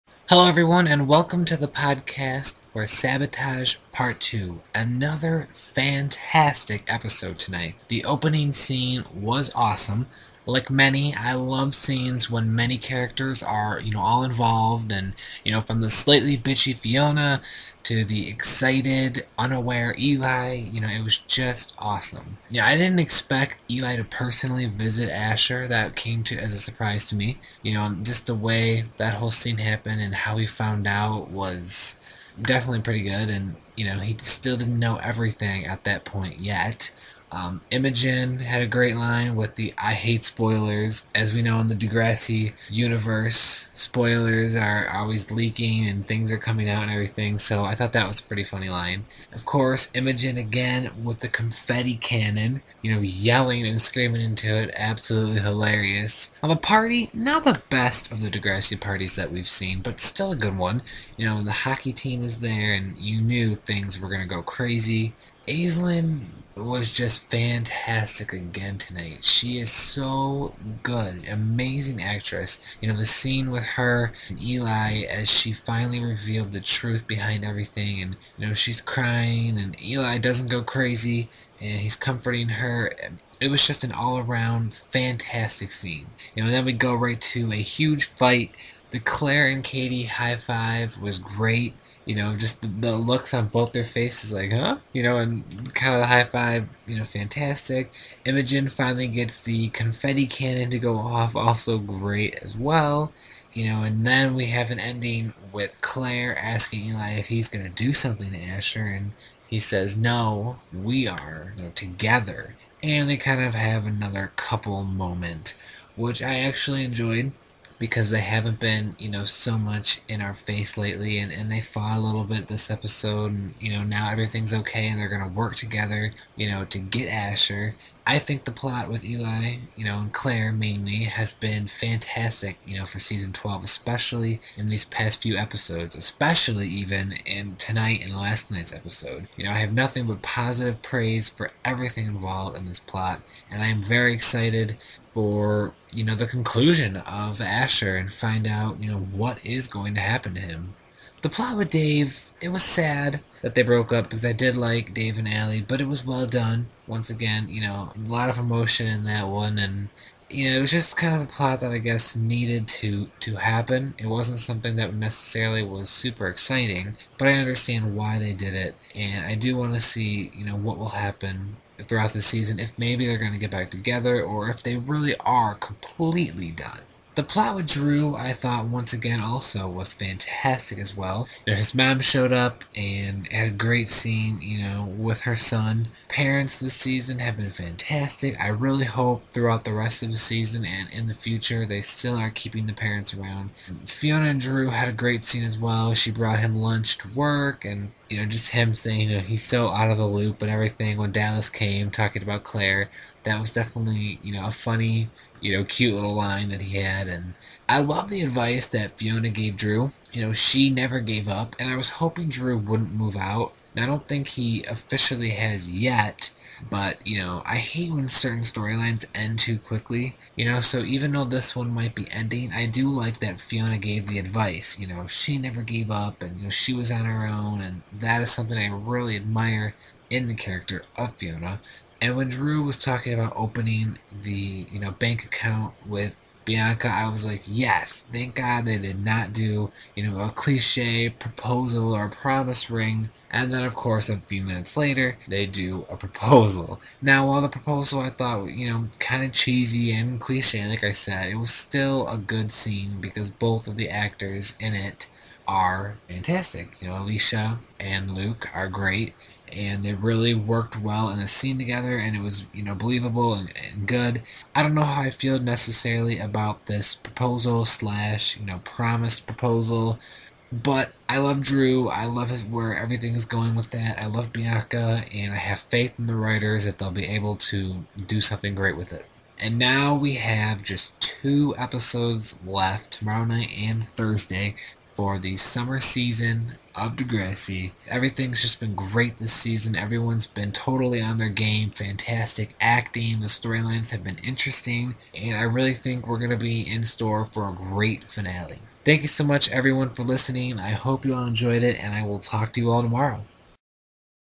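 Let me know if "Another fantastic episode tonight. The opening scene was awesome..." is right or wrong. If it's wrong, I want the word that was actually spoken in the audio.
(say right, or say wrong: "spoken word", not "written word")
right.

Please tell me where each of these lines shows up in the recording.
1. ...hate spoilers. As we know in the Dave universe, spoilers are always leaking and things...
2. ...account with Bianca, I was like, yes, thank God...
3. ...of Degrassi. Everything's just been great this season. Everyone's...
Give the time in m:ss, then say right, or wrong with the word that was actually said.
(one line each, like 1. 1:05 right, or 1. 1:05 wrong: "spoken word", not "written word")
1. 0:39 wrong: "Degrassi", not "Dave"
2. 3:55 right
3. 4:46 right.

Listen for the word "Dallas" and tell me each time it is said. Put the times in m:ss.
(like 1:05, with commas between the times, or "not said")
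3:21.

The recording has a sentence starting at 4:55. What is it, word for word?
And I really think we're going to be in store for a great finale.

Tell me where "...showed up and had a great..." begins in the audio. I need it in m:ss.
3:01.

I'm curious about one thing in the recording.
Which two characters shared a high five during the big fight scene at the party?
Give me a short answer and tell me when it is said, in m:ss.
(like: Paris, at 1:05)
Clare and Katie, at 1:28.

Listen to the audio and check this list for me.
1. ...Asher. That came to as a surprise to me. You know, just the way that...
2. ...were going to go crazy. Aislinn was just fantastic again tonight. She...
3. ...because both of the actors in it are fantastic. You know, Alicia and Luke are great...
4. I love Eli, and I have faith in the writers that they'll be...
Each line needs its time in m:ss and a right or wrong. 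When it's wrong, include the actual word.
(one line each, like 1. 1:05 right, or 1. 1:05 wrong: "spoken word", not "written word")
1. 0:25 right
2. 1:04 right
3. 4:12 right
4. 4:34 wrong: "Bianca", not "Eli".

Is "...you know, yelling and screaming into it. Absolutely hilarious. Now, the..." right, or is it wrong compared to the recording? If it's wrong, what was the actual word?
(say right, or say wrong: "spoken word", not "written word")
right.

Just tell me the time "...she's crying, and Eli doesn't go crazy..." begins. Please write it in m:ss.
1:18.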